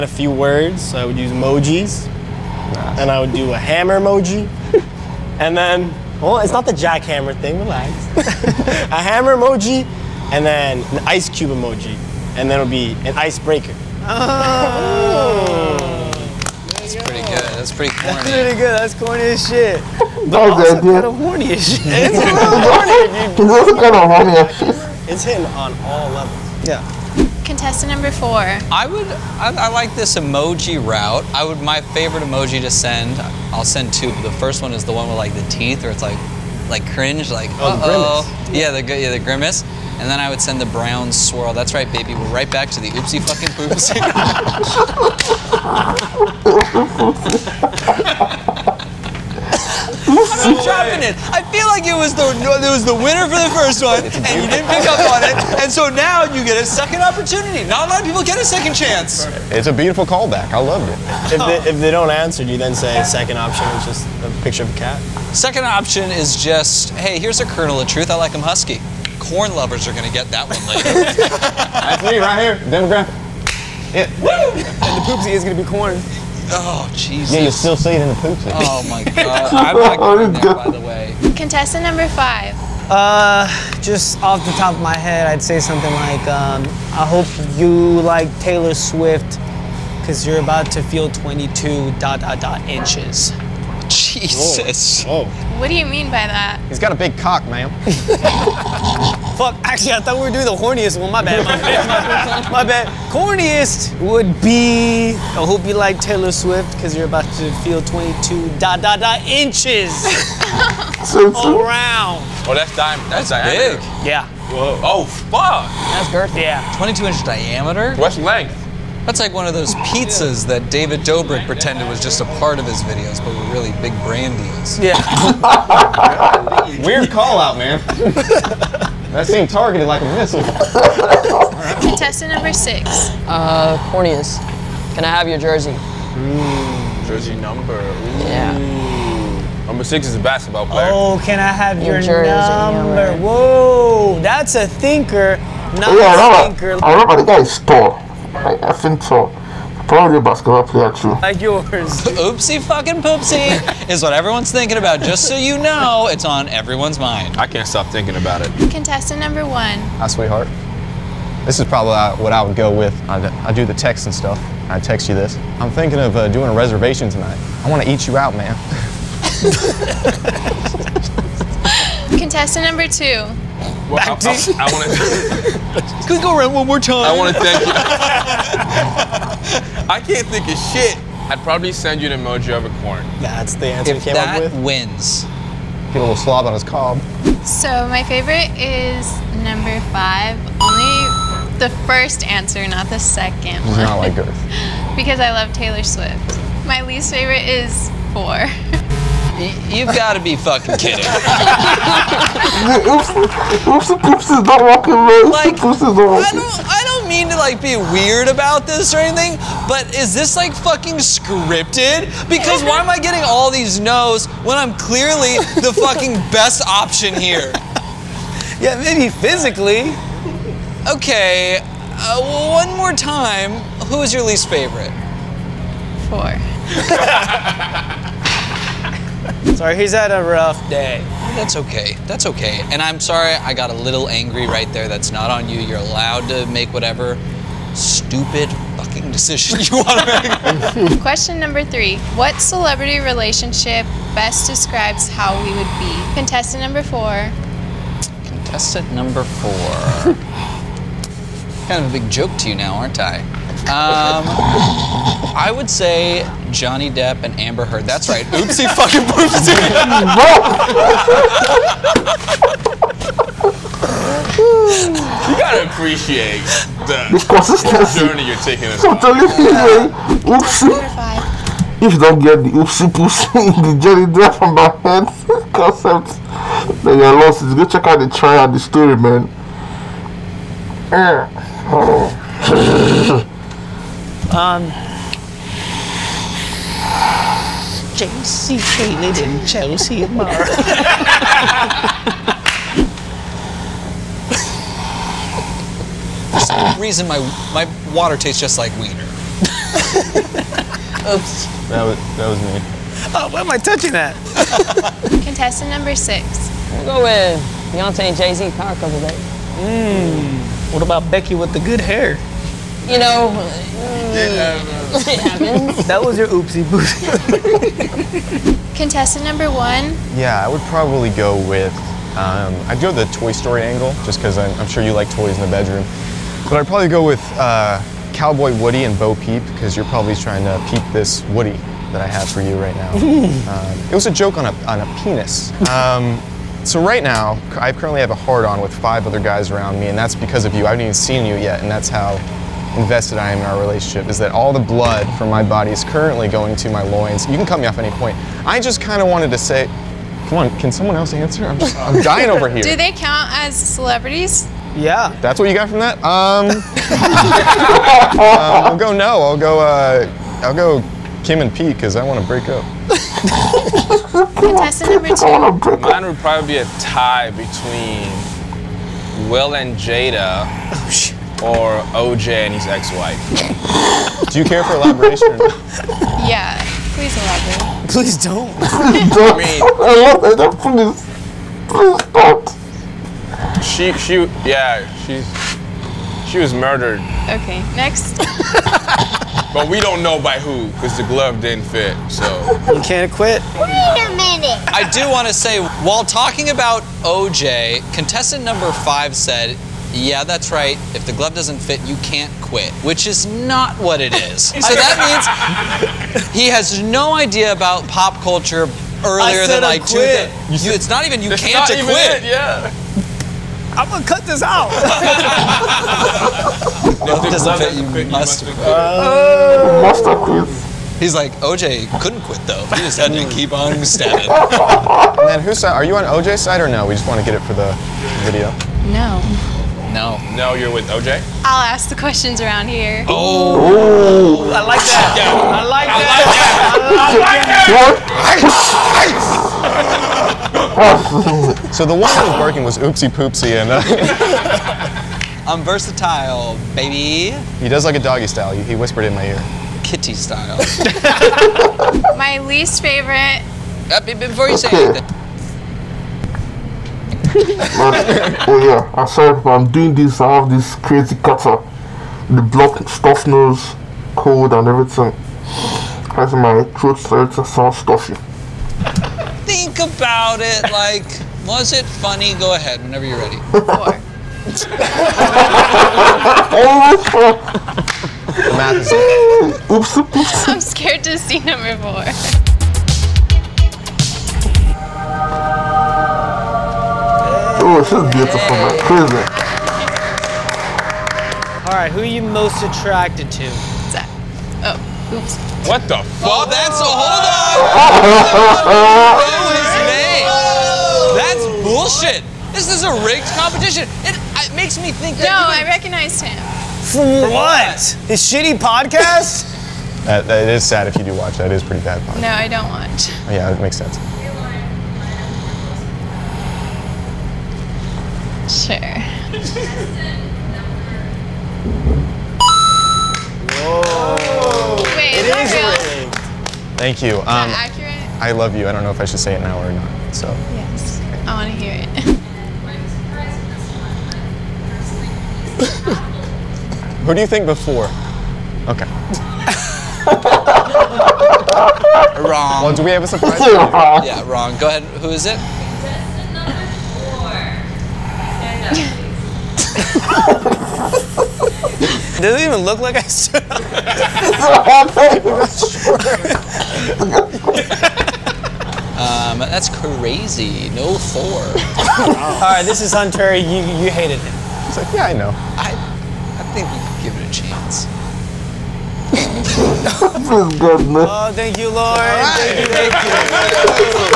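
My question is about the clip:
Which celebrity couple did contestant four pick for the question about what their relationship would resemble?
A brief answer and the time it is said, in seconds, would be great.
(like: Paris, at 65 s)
Johnny Depp and Amber Heard, at 256 s.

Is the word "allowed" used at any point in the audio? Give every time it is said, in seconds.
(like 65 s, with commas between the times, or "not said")
235 s.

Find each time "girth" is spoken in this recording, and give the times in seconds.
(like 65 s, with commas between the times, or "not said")
116 s, 194 s.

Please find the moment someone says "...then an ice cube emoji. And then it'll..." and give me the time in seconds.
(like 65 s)
10 s.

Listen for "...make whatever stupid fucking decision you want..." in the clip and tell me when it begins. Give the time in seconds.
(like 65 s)
236 s.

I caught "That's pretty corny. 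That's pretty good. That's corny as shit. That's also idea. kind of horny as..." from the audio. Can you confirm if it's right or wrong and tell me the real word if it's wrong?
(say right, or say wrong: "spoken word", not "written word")
right.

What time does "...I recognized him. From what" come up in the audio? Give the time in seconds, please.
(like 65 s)
505 s.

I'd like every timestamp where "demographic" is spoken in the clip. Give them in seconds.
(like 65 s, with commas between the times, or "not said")
72 s.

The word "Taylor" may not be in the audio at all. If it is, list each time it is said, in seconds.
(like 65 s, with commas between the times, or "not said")
88 s, 105 s, 195 s.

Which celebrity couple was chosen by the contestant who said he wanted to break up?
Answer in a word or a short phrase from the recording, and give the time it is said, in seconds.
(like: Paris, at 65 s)
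Kim and Pete, at 361 s.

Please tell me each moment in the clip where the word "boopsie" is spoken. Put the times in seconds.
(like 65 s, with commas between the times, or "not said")
259 s, 316 s.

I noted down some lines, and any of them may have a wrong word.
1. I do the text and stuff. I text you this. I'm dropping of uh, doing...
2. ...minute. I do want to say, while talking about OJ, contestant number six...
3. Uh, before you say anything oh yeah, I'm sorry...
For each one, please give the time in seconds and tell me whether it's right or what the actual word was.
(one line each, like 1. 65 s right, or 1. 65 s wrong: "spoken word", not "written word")
1. 163 s wrong: "thinking", not "dropping"
2. 394 s wrong: "five", not "six"
3. 453 s right.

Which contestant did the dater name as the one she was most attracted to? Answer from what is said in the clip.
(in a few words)
Zach.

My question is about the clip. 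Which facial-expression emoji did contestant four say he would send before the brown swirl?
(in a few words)
grimace.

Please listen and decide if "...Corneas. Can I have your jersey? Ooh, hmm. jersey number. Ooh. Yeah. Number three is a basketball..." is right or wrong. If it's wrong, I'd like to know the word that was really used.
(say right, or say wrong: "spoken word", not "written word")
wrong: "six", not "three".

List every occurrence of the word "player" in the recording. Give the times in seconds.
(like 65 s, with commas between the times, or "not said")
140 s, 150 s.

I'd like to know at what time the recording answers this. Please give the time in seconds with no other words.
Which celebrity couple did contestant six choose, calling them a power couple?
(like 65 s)
307 s.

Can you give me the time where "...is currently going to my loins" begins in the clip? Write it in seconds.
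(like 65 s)
345 s.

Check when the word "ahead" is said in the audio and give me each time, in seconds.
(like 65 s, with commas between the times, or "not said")
472 s, 544 s.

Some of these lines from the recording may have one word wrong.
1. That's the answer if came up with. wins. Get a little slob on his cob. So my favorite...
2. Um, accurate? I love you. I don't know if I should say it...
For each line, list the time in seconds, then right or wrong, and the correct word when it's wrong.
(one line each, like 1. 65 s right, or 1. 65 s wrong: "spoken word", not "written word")
1. 183 s right
2. 527 s right.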